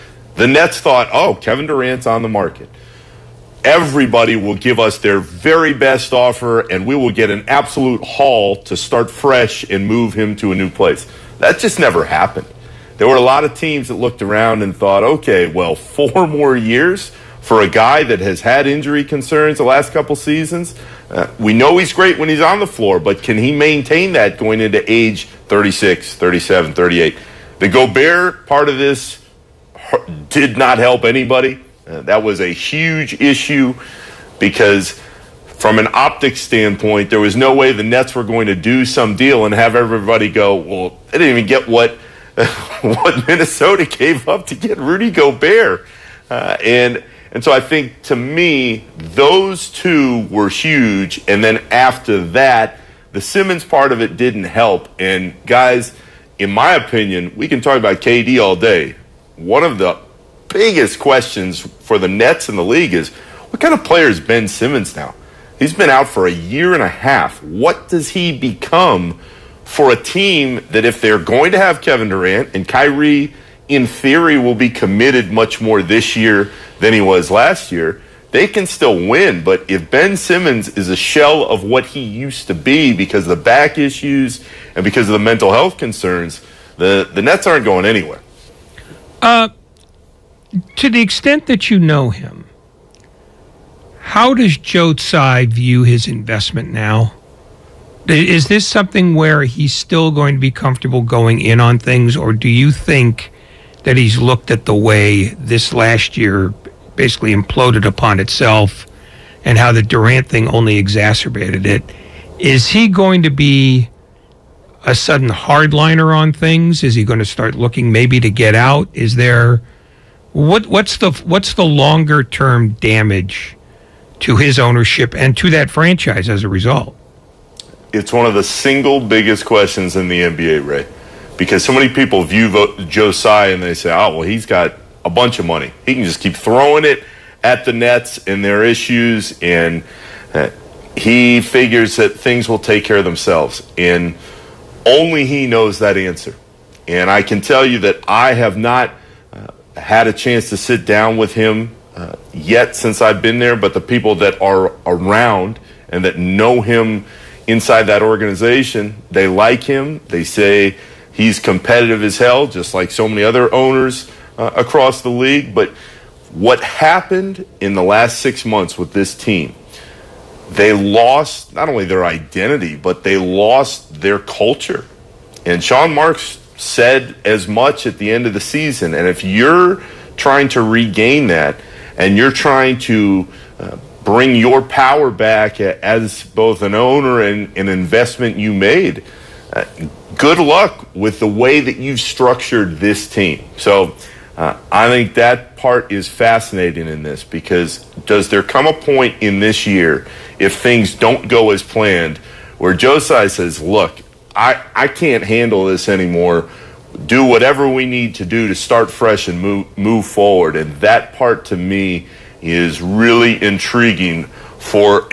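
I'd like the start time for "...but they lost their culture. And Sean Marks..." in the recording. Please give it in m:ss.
2:52.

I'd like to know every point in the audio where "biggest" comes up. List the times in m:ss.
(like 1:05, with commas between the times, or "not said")
1:00, 2:08.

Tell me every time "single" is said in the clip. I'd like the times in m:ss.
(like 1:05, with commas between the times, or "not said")
2:08.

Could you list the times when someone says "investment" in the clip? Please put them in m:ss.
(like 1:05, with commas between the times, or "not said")
1:36, 3:07.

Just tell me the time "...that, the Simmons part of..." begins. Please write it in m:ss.
0:52.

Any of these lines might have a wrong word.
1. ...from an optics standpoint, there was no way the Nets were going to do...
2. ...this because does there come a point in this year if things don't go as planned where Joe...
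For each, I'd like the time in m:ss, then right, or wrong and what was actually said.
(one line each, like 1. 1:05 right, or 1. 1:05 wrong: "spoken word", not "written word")
1. 0:35 right
2. 3:17 right.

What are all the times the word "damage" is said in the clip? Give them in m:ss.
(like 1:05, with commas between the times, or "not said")
2:02.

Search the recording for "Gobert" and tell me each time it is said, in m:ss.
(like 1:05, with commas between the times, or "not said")
0:27, 0:45.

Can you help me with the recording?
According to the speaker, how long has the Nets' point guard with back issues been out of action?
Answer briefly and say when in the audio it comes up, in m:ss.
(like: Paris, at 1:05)
A year and a half, at 1:06.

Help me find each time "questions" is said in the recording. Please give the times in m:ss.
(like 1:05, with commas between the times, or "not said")
1:00, 2:09.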